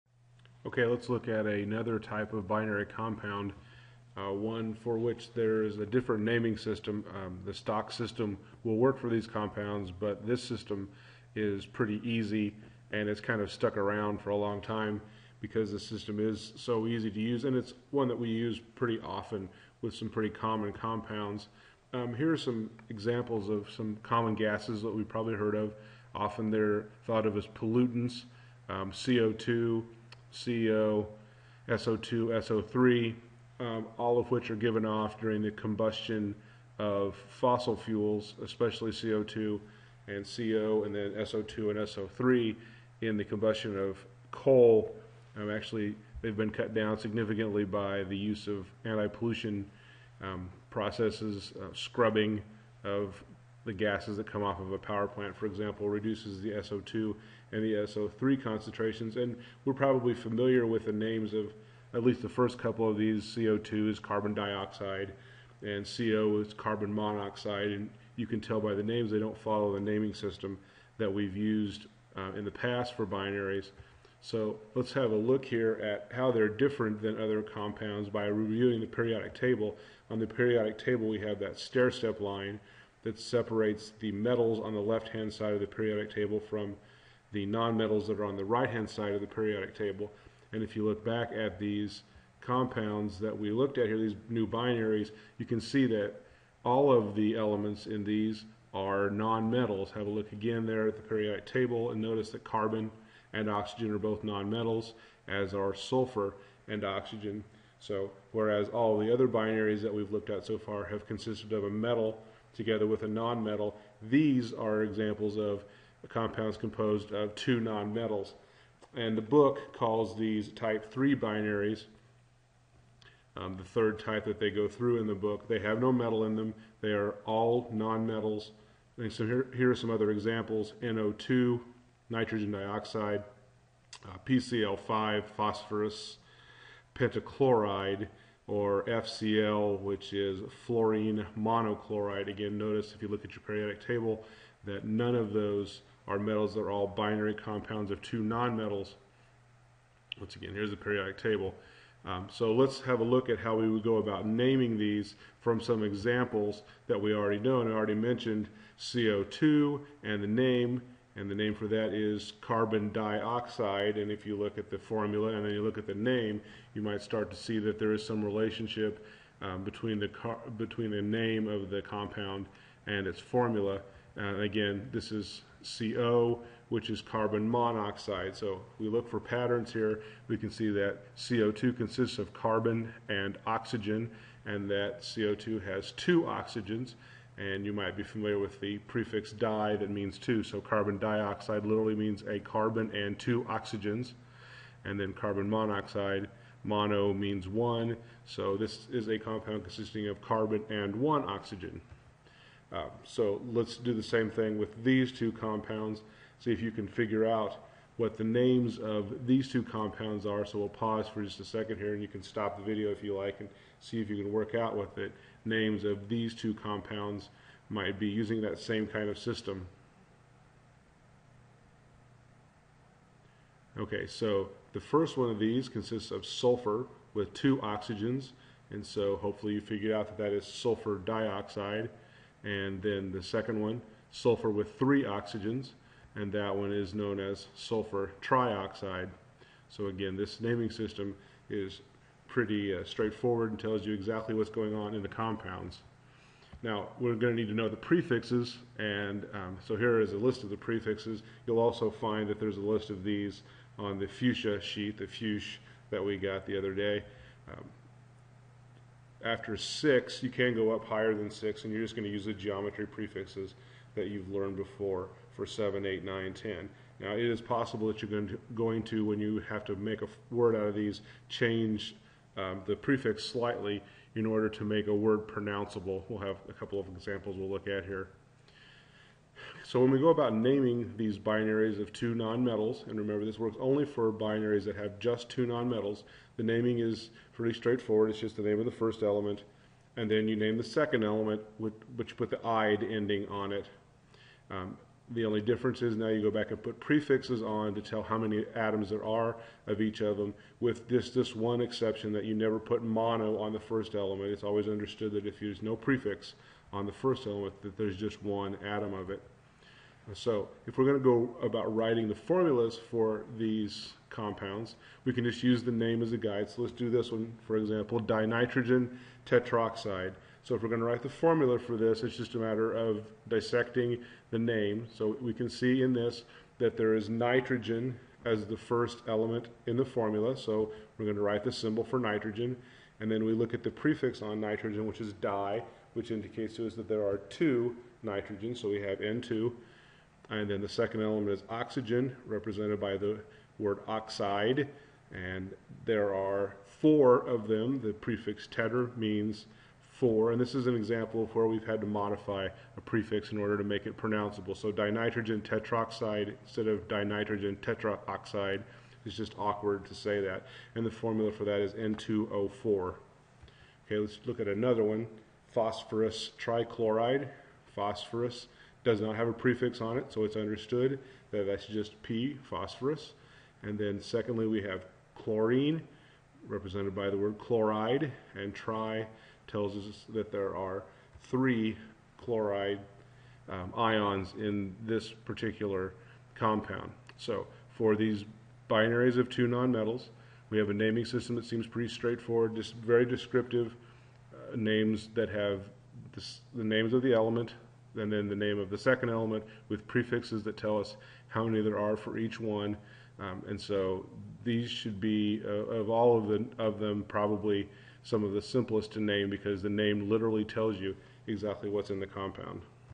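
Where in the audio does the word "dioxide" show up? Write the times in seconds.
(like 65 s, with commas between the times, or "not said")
64 s, 132 s, 162 s, 190 s, 230 s.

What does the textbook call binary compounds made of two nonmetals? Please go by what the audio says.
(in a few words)
Type 3 binaries.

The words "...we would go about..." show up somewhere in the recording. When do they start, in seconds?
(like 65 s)
153 s.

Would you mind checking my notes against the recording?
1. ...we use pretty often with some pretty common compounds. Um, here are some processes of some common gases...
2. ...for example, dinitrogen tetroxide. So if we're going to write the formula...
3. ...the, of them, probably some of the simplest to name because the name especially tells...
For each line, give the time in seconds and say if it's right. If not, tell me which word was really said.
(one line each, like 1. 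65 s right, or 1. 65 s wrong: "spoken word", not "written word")
1. 18 s wrong: "examples", not "processes"
2. 317 s right
3. 406 s wrong: "literally", not "especially".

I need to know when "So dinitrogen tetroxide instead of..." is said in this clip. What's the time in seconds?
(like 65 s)
354 s.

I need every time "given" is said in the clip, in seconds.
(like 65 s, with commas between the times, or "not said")
34 s.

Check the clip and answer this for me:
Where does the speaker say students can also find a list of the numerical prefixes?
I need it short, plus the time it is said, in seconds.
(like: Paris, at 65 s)
The fuchsia sheet, at 253 s.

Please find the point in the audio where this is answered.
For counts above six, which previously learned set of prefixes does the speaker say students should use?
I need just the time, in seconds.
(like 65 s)
262 s.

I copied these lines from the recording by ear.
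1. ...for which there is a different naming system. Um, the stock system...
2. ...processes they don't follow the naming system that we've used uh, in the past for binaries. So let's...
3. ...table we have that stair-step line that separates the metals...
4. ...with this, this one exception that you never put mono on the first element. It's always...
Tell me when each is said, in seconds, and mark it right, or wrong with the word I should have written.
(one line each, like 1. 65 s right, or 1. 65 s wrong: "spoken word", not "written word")
1. 4 s right
2. 68 s wrong: "names", not "processes"
3. 80 s right
4. 300 s right.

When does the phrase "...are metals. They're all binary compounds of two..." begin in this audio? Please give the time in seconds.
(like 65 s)
146 s.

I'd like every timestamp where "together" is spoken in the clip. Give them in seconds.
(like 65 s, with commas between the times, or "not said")
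112 s.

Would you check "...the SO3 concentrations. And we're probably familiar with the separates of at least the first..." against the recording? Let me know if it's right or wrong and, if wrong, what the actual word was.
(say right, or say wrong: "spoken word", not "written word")
wrong: "names", not "separates".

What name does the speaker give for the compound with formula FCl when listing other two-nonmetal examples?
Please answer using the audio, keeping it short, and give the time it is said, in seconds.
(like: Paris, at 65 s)
Fluorine monochloride, at 140 s.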